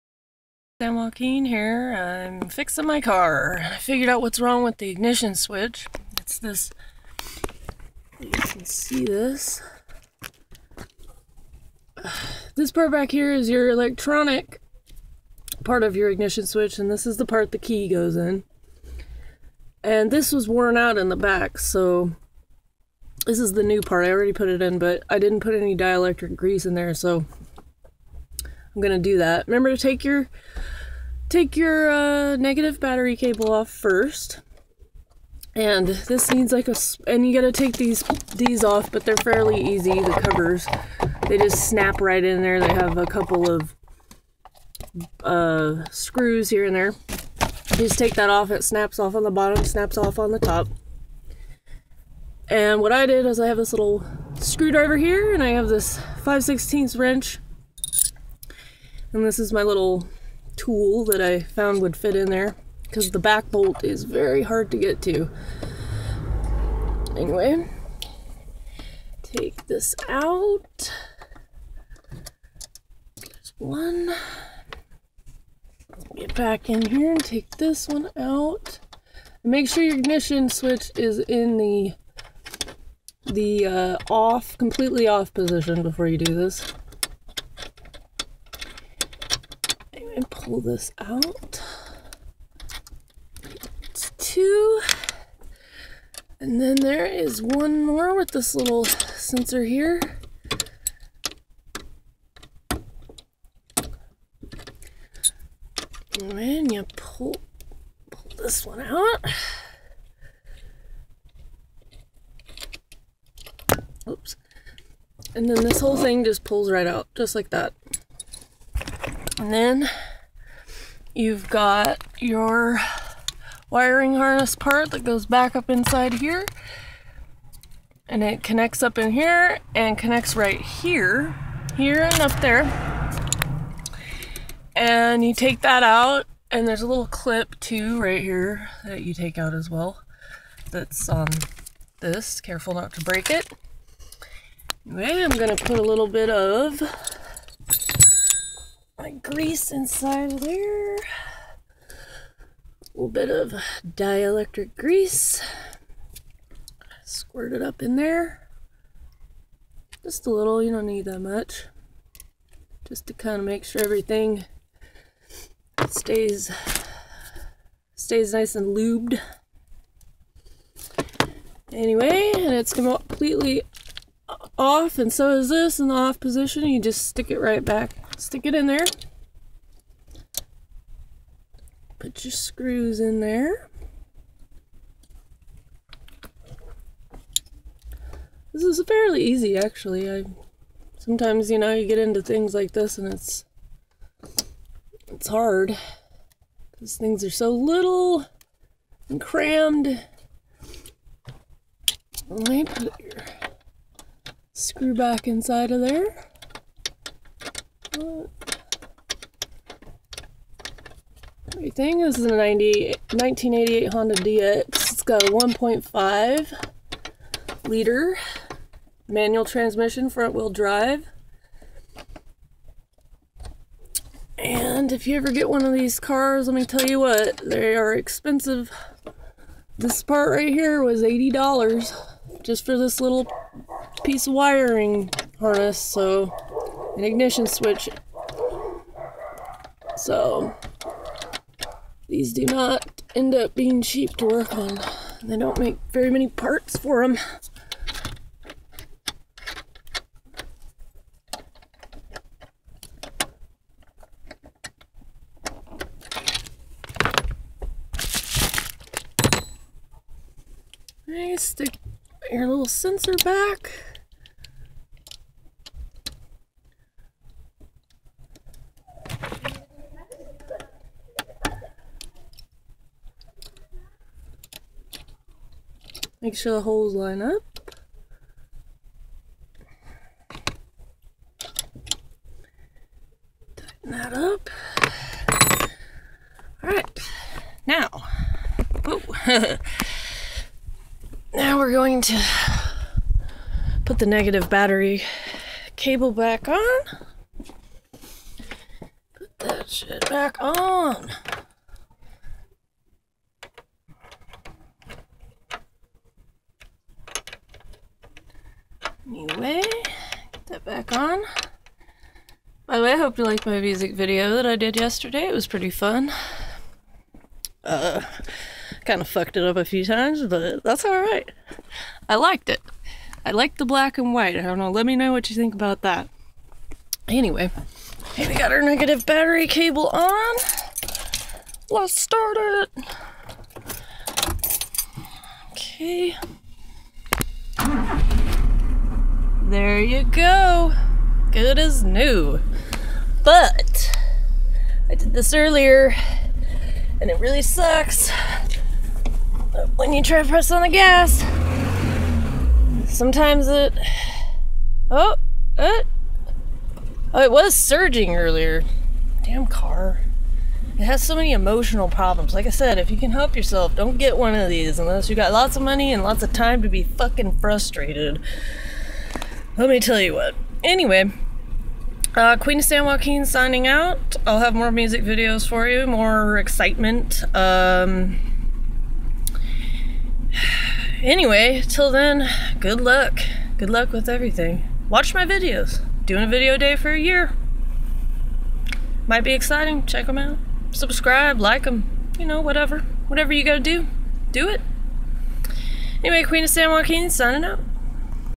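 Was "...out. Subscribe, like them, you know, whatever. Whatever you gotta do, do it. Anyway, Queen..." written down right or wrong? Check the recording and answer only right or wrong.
right.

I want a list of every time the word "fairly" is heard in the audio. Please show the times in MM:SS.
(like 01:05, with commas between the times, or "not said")
00:39, 03:08.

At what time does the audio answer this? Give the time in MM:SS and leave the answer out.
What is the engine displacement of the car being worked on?
03:35.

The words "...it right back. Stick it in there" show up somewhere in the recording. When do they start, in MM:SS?
02:57.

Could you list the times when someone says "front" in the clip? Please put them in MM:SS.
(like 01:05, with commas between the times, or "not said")
03:40.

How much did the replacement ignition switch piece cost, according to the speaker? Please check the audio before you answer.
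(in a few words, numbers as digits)
$80.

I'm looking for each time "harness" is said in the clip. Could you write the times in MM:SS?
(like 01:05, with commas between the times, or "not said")
02:04, 03:55.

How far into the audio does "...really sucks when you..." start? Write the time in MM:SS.
05:47.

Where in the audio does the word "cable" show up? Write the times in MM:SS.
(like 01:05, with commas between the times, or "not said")
00:33, 04:55, 05:29.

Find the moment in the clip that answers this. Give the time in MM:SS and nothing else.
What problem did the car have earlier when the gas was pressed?
05:57.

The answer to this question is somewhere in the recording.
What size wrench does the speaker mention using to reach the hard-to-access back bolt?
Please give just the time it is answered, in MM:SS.
00:56.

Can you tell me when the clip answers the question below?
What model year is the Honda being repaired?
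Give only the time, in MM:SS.
03:33.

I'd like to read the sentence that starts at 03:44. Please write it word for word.
And if you ever get one of these cars, let me tell you what, they are expensive.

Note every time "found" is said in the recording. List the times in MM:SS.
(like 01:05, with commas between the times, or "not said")
01:01.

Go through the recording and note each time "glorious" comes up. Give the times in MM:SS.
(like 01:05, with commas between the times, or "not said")
not said.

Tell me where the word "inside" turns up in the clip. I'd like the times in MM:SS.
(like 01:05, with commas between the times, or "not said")
02:05, 02:29, 03:25.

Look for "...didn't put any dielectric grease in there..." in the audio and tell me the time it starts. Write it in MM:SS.
00:25.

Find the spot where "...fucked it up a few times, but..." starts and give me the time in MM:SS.
05:19.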